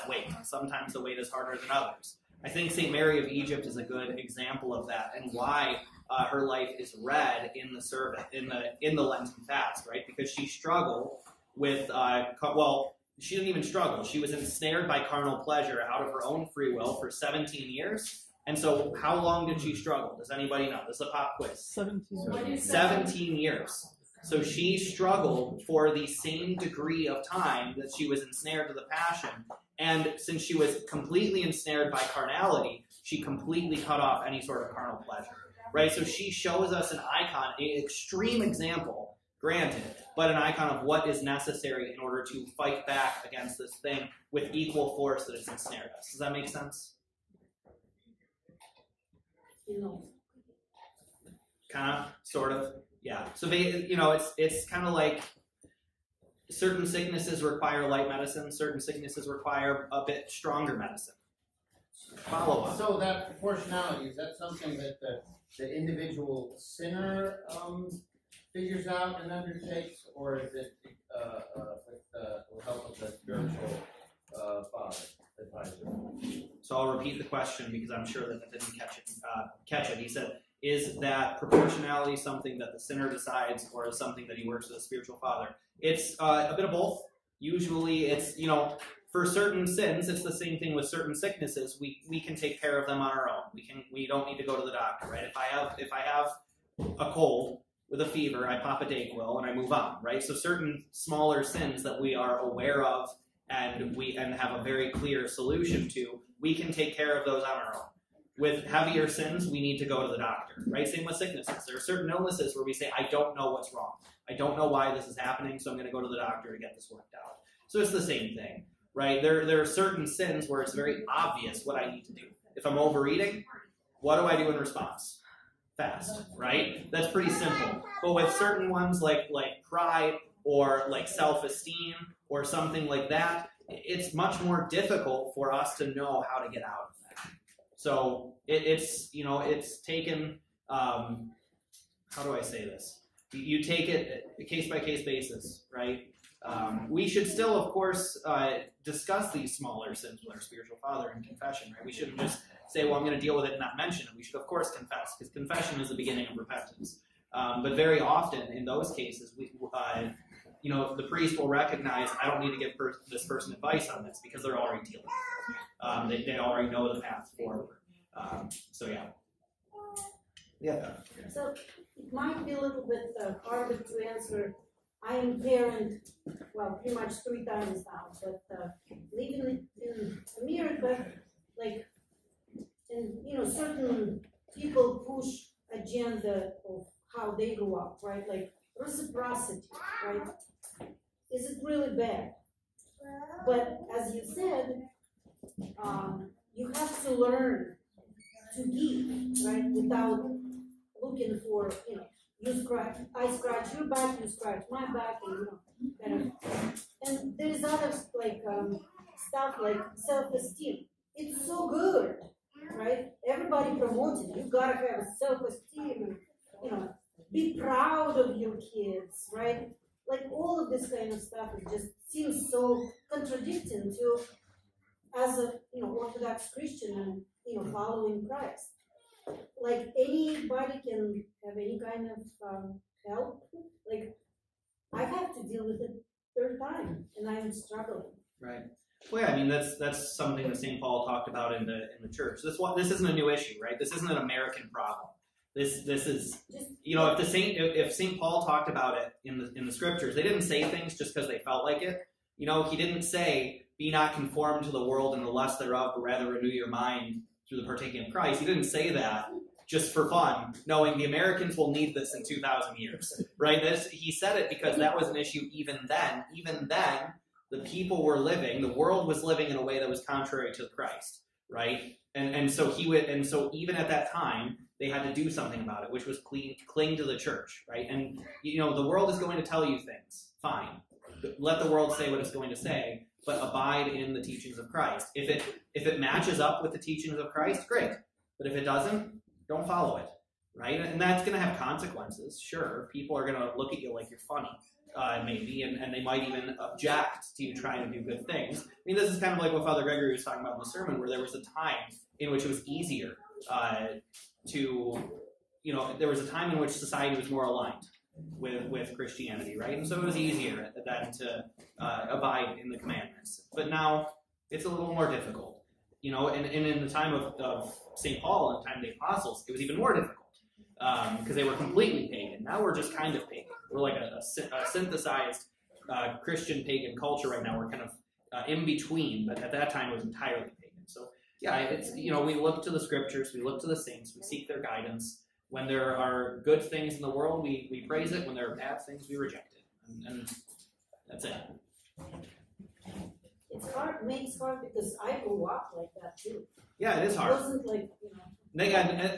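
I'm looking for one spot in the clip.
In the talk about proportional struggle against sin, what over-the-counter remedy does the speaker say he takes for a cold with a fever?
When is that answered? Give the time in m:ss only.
1:38.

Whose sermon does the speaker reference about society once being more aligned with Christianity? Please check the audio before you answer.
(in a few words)
Father Gregory.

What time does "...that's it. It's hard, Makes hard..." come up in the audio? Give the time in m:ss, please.
5:41.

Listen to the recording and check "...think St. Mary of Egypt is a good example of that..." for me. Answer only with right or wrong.
right.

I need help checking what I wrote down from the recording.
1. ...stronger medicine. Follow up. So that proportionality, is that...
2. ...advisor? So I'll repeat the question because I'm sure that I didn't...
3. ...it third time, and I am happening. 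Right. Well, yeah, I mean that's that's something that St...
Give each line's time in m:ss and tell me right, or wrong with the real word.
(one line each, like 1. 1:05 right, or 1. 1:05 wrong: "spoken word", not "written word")
1. 1:00 right
2. 1:15 right
3. 3:55 wrong: "struggling", not "happening".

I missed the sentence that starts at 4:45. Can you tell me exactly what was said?
If it if it matches up with the teachings of Christ, great.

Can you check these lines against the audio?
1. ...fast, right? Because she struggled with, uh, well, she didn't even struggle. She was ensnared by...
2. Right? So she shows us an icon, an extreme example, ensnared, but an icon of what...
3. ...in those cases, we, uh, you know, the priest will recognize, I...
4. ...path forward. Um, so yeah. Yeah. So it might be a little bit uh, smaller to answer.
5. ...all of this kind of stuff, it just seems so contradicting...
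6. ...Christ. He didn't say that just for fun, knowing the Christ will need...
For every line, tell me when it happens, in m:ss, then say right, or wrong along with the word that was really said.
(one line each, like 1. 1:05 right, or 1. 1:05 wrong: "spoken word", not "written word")
1. 0:09 right
2. 0:35 wrong: "granted", not "ensnared"
3. 2:38 right
4. 2:47 wrong: "harder", not "smaller"
5. 3:40 right
6. 4:18 wrong: "Americans", not "Christ".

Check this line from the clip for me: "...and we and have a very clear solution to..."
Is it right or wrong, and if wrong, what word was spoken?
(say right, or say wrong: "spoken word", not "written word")
right.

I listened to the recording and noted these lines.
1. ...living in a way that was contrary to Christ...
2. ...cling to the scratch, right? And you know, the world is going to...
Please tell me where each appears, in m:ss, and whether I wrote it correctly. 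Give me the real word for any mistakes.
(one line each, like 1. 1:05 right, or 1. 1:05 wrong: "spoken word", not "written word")
1. 4:29 right
2. 4:36 wrong: "church", not "scratch".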